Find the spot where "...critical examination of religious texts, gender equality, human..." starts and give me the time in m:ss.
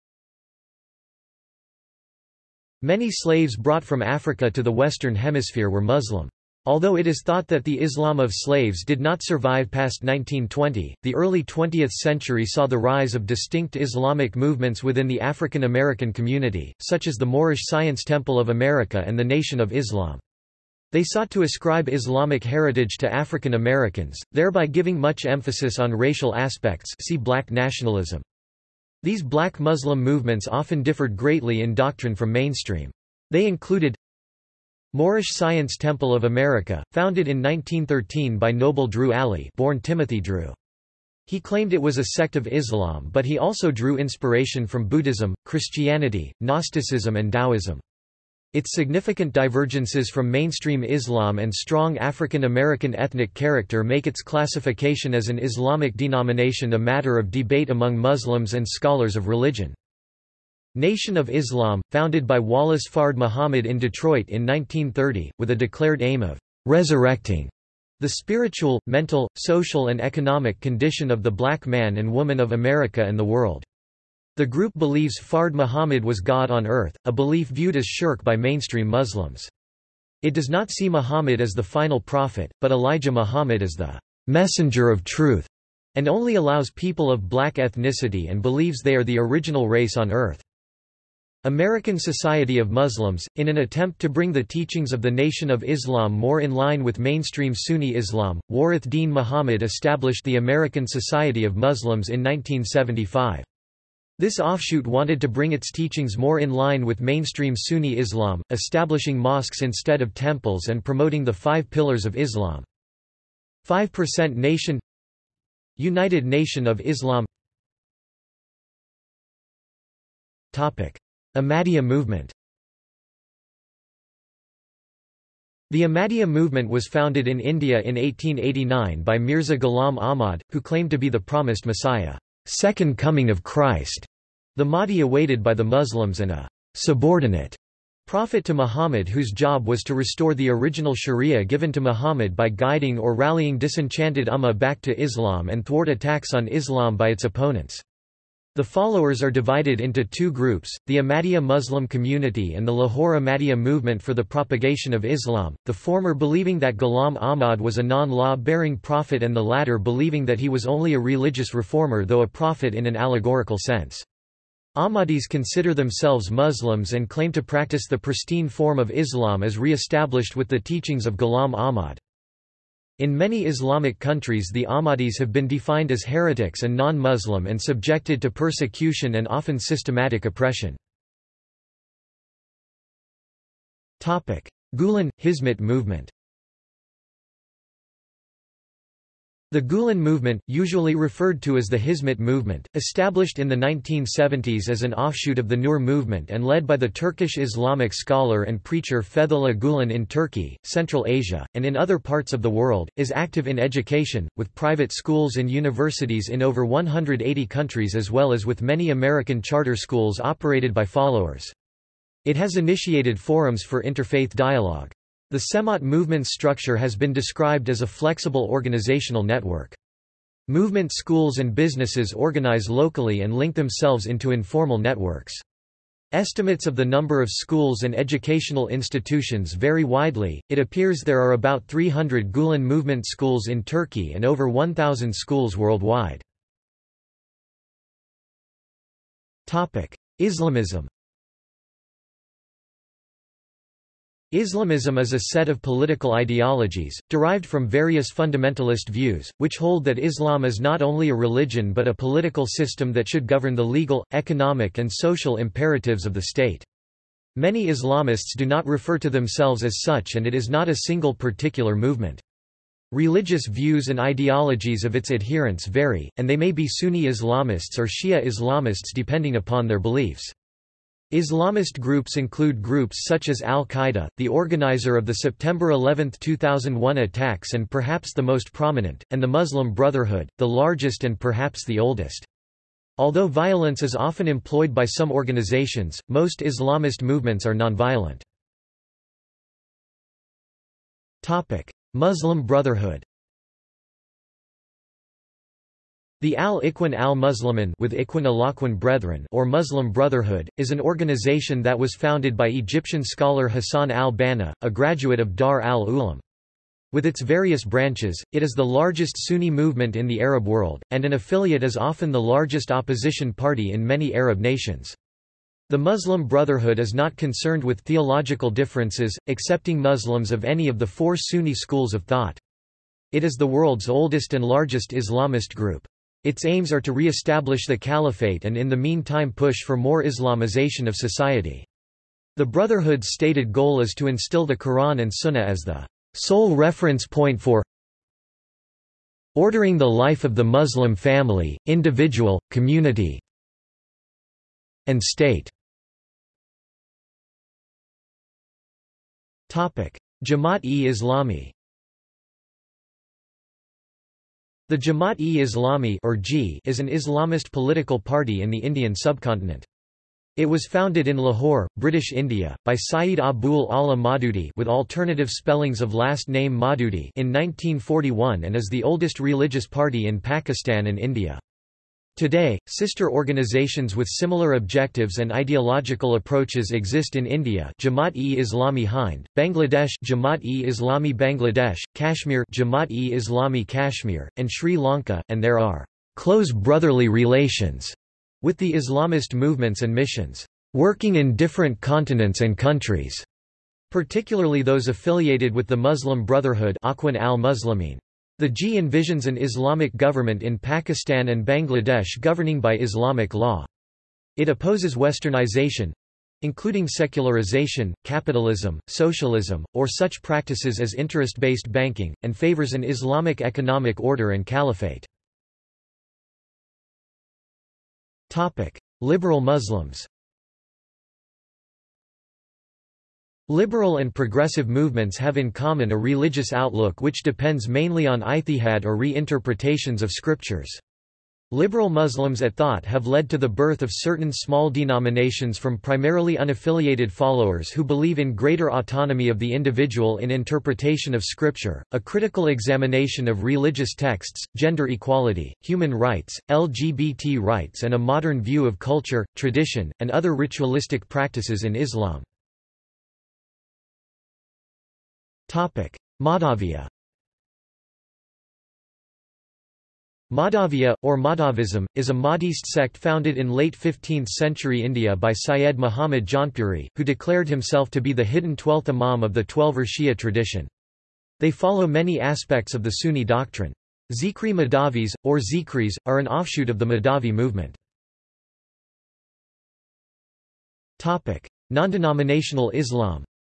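7:22.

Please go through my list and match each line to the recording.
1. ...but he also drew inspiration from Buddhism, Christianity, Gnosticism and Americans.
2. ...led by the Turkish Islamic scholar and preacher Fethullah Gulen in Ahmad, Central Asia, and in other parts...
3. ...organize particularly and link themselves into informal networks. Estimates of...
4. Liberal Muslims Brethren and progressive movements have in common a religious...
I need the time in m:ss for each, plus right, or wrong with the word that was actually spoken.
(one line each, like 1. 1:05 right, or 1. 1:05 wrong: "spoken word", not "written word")
1. 0:43 wrong: "Taoism", not "Americans"
2. 3:16 wrong: "Turkey", not "Ahmad"
3. 3:42 wrong: "locally", not "particularly"
4. 6:59 wrong: "Liberal", not "Brethren".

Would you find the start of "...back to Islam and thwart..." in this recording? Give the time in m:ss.
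2:24.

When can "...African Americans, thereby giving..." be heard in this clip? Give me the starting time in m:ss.
0:23.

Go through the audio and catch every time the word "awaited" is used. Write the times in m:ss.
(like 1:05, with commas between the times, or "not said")
2:15.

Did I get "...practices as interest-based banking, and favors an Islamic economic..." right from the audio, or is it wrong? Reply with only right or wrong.
right.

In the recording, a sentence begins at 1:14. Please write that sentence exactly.
The group believes Fard Muhammad was God on earth, a belief viewed as shirk by mainstream Muslims.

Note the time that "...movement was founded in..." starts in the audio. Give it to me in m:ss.
2:06.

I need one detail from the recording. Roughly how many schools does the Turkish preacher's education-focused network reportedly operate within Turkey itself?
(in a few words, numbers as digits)
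About 300.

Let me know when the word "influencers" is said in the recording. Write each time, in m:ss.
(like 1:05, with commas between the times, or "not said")
not said.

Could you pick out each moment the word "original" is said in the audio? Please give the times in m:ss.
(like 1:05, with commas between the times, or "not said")
1:29, 2:20.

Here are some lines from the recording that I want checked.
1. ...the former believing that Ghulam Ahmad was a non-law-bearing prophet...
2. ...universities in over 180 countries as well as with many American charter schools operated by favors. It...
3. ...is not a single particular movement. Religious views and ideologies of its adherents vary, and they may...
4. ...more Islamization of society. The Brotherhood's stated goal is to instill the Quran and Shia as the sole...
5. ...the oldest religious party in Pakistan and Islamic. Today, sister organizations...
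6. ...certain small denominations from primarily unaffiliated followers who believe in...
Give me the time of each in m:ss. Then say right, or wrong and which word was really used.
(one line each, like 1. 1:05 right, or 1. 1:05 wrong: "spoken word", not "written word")
1. 2:35 right
2. 3:25 wrong: "followers", not "favors"
3. 4:20 right
4. 5:29 wrong: "Sunnah", not "Shia"
5. 6:08 wrong: "India", not "Islamic"
6. 7:13 right.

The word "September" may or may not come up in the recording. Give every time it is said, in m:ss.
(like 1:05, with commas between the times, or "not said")
4:35.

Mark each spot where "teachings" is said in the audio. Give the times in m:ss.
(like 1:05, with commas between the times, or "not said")
1:34, 1:45, 2:50.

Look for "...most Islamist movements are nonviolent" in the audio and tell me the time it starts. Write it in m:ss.
4:46.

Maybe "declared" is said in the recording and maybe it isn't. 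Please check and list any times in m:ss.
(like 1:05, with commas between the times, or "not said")
1:05, 7:47.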